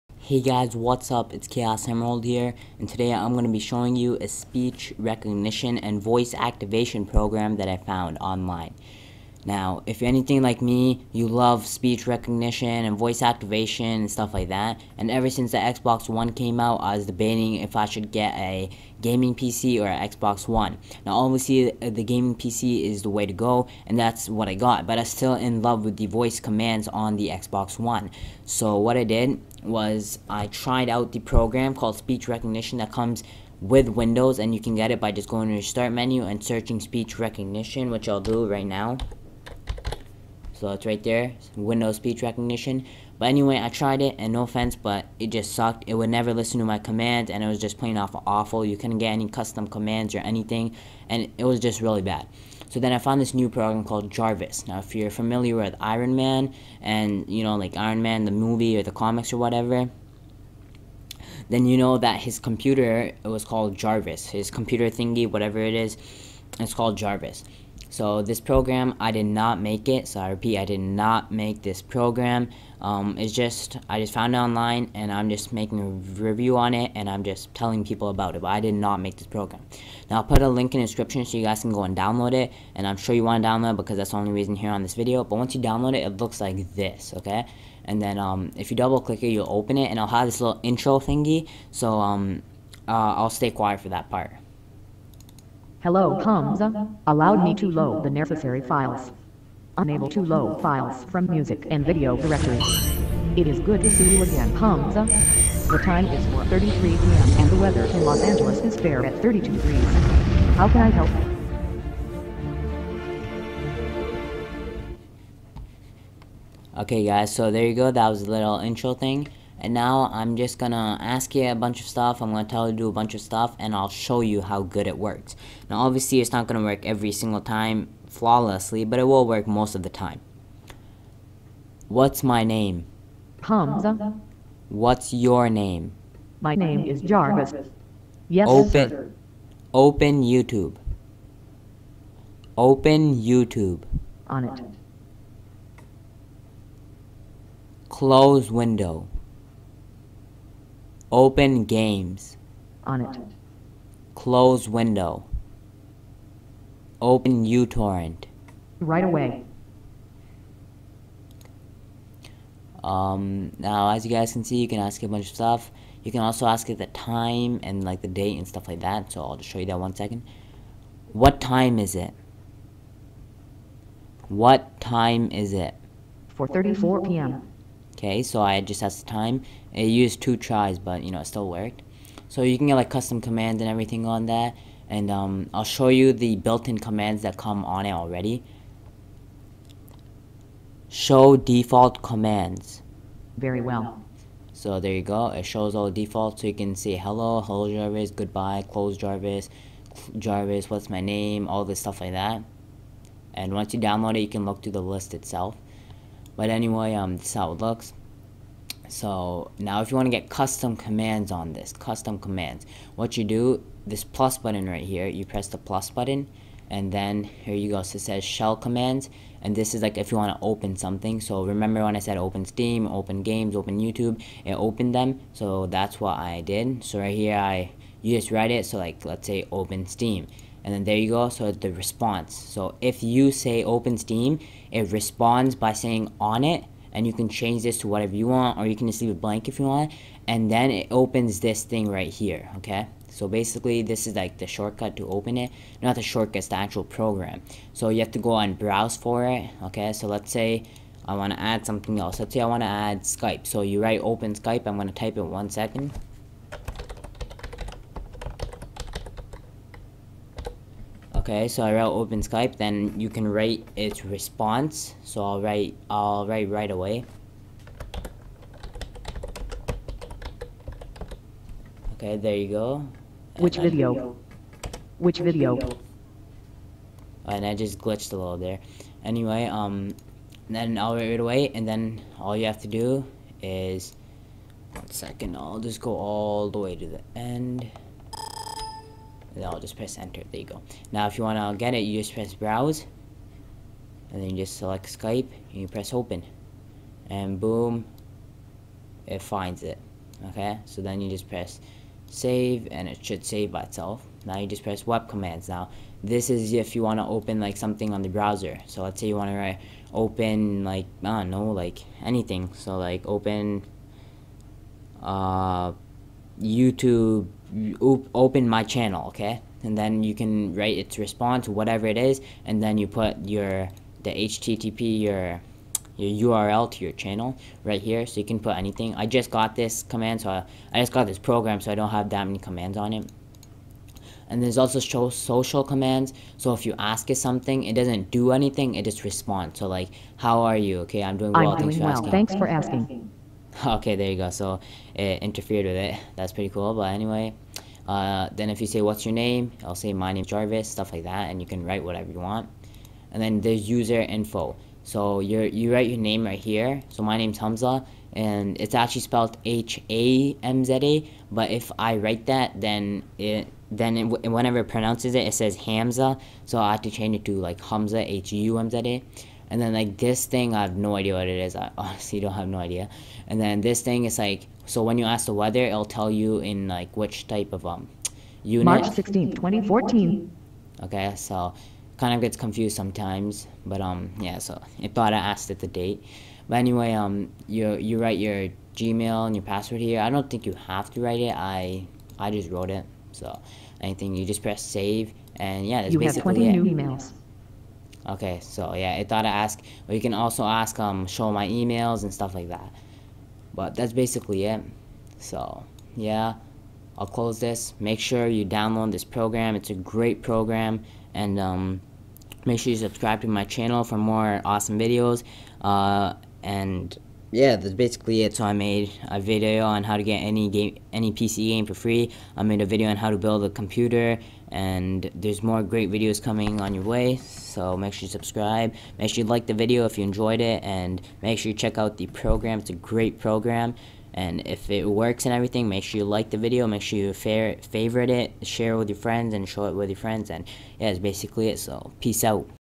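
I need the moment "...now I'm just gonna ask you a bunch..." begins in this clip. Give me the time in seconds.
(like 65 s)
119 s.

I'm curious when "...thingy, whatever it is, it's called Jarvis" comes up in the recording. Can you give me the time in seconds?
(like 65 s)
64 s.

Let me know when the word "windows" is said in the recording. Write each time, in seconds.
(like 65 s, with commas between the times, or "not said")
33 s, 41 s, 148 s, 154 s.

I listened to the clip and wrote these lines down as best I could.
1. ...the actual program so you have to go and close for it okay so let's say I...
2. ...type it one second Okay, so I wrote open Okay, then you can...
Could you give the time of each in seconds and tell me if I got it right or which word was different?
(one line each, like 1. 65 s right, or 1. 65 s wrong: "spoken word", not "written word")
1. 246 s wrong: "browse", not "close"
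2. 254 s wrong: "Skype", not "Okay".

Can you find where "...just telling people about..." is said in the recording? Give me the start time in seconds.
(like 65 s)
77 s.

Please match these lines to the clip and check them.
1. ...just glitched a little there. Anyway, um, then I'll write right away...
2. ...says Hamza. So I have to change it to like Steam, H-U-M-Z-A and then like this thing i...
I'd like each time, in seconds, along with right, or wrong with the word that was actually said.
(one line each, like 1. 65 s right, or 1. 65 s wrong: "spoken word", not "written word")
1. 277 s right
2. 365 s wrong: "Hamza", not "Steam".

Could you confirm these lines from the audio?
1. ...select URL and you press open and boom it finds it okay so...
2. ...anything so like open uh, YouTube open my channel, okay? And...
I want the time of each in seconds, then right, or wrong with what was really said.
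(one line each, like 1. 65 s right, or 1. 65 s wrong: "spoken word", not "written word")
1. 294 s wrong: "Skype", not "URL"
2. 312 s right.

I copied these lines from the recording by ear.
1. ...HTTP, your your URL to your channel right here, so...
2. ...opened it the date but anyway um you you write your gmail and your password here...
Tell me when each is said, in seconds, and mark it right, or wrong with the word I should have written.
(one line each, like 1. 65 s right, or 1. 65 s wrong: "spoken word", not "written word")
1. 324 s right
2. 385 s wrong: "asked", not "opened".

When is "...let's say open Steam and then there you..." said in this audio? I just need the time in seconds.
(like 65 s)
229 s.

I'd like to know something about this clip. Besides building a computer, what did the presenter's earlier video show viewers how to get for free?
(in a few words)
any PC game.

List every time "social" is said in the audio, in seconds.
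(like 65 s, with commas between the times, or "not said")
335 s.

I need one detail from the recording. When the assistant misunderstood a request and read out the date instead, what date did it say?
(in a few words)
March 16, 2014.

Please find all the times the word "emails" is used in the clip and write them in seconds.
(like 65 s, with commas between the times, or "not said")
396 s, 401 s.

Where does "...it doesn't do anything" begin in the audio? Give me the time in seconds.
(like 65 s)
337 s.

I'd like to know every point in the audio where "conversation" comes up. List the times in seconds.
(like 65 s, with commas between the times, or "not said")
not said.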